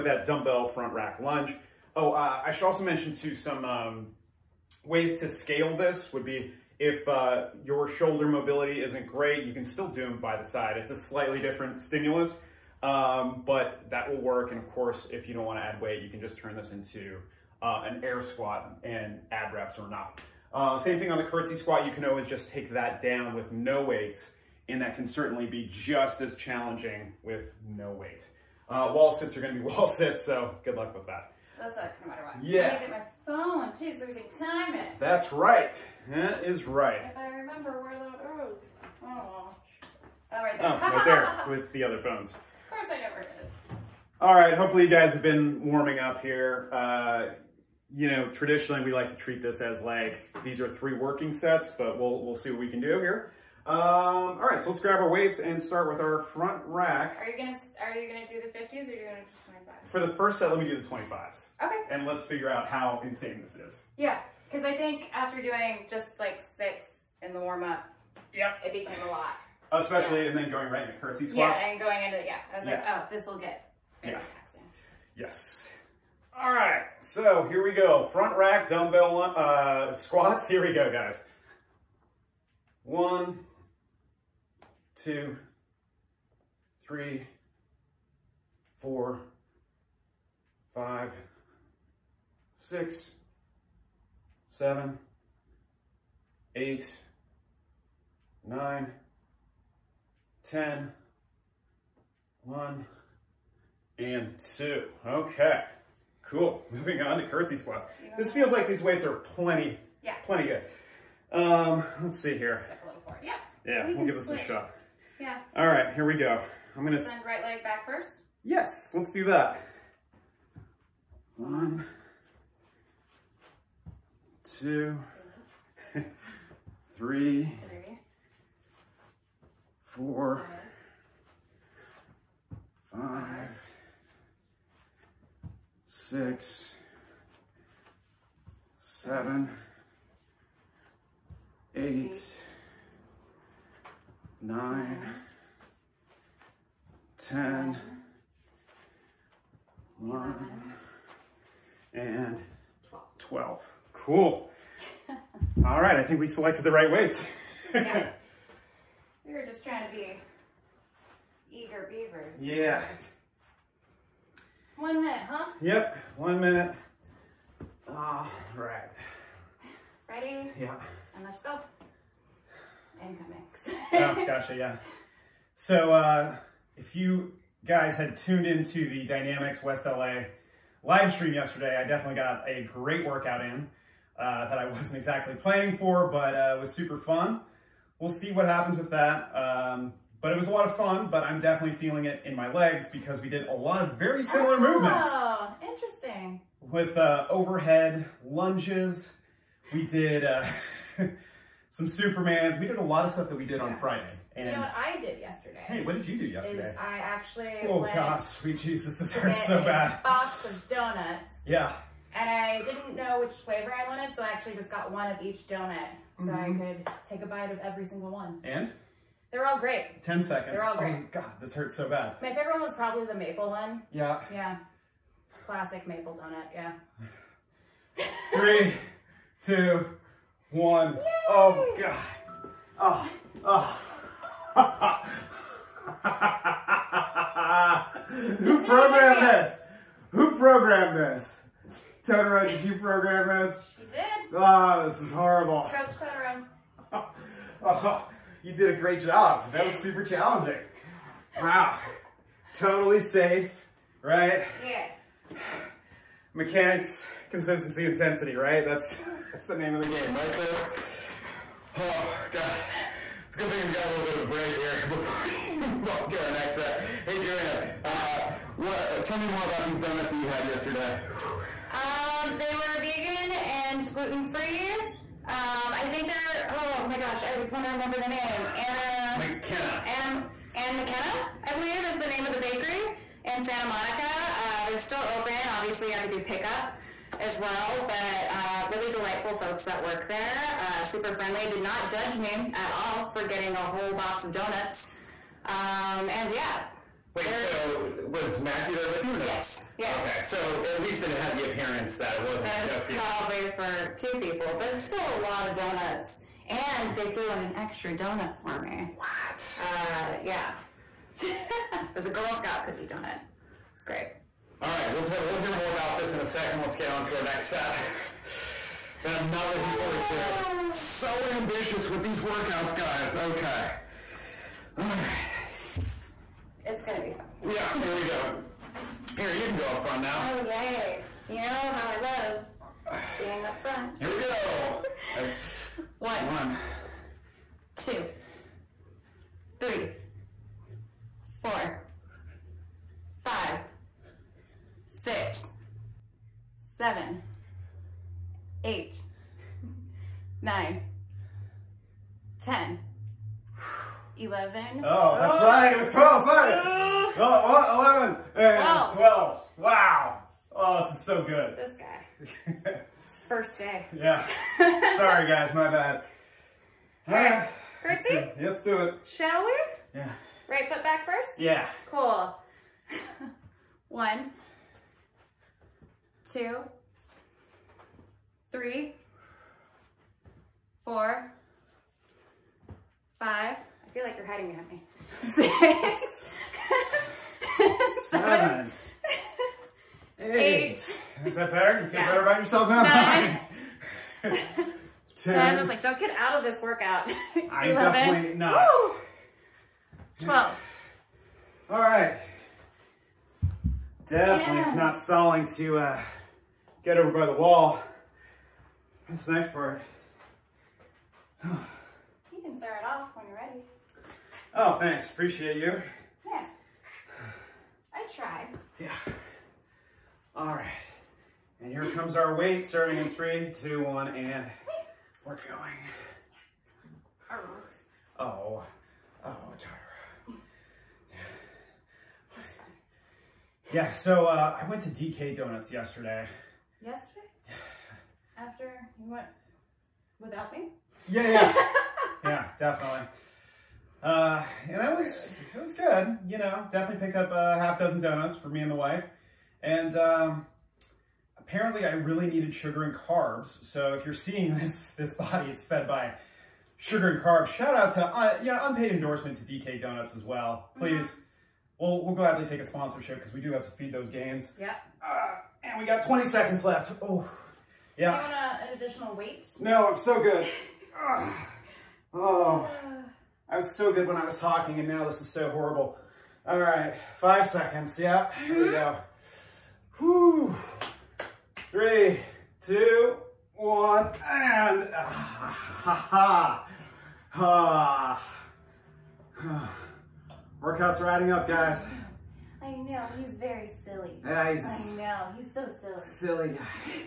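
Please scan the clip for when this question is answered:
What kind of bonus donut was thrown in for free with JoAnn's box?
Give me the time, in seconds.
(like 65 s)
312 s.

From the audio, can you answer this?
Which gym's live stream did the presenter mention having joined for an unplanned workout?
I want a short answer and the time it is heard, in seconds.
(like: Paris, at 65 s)
Dynamics West LA, at 179 s.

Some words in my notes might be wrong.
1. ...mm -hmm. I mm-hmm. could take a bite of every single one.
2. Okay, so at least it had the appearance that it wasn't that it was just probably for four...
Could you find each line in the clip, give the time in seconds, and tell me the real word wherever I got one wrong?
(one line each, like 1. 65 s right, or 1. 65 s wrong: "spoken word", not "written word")
1. 216 s right
2. 299 s wrong: "two", not "four".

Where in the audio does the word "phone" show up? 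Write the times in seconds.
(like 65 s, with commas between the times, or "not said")
33 s, 41 s.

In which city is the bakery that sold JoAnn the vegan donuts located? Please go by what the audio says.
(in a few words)
Santa Monica.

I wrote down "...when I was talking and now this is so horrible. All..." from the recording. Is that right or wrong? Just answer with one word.
right.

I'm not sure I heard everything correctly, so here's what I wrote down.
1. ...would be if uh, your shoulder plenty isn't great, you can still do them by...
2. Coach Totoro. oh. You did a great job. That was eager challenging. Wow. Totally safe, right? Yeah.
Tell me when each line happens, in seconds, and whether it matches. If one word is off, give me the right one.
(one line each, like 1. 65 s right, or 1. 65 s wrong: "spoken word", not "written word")
1. 6 s wrong: "mobility", not "plenty"
2. 245 s wrong: "super", not "eager".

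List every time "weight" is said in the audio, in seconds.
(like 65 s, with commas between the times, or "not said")
15 s, 23 s, 27 s, 55 s, 108 s, 156 s, 422 s, 469 s.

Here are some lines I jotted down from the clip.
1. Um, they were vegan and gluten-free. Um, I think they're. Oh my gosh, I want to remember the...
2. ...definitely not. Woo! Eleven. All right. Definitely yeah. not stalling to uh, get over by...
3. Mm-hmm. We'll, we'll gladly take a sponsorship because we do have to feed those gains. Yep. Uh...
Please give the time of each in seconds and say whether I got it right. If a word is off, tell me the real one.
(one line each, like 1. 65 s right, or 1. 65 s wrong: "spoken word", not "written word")
1. 271 s right
2. 397 s wrong: "Twelve", not "Eleven"
3. 461 s right.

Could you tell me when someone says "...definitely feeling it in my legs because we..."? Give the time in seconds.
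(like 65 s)
191 s.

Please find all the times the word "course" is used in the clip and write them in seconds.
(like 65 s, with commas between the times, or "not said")
14 s, 42 s.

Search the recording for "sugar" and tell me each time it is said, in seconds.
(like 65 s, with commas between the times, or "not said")
452 s, 456 s.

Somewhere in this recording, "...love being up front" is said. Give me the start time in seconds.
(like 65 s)
332 s.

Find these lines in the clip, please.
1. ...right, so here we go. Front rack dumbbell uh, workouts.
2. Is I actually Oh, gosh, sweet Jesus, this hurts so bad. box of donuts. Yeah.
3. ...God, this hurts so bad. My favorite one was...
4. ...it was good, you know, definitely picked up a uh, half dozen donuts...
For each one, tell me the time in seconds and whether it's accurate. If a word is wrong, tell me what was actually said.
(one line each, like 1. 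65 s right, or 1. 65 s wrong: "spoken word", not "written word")
1. 76 s wrong: "squats", not "workouts"
2. 206 s right
3. 221 s right
4. 445 s right.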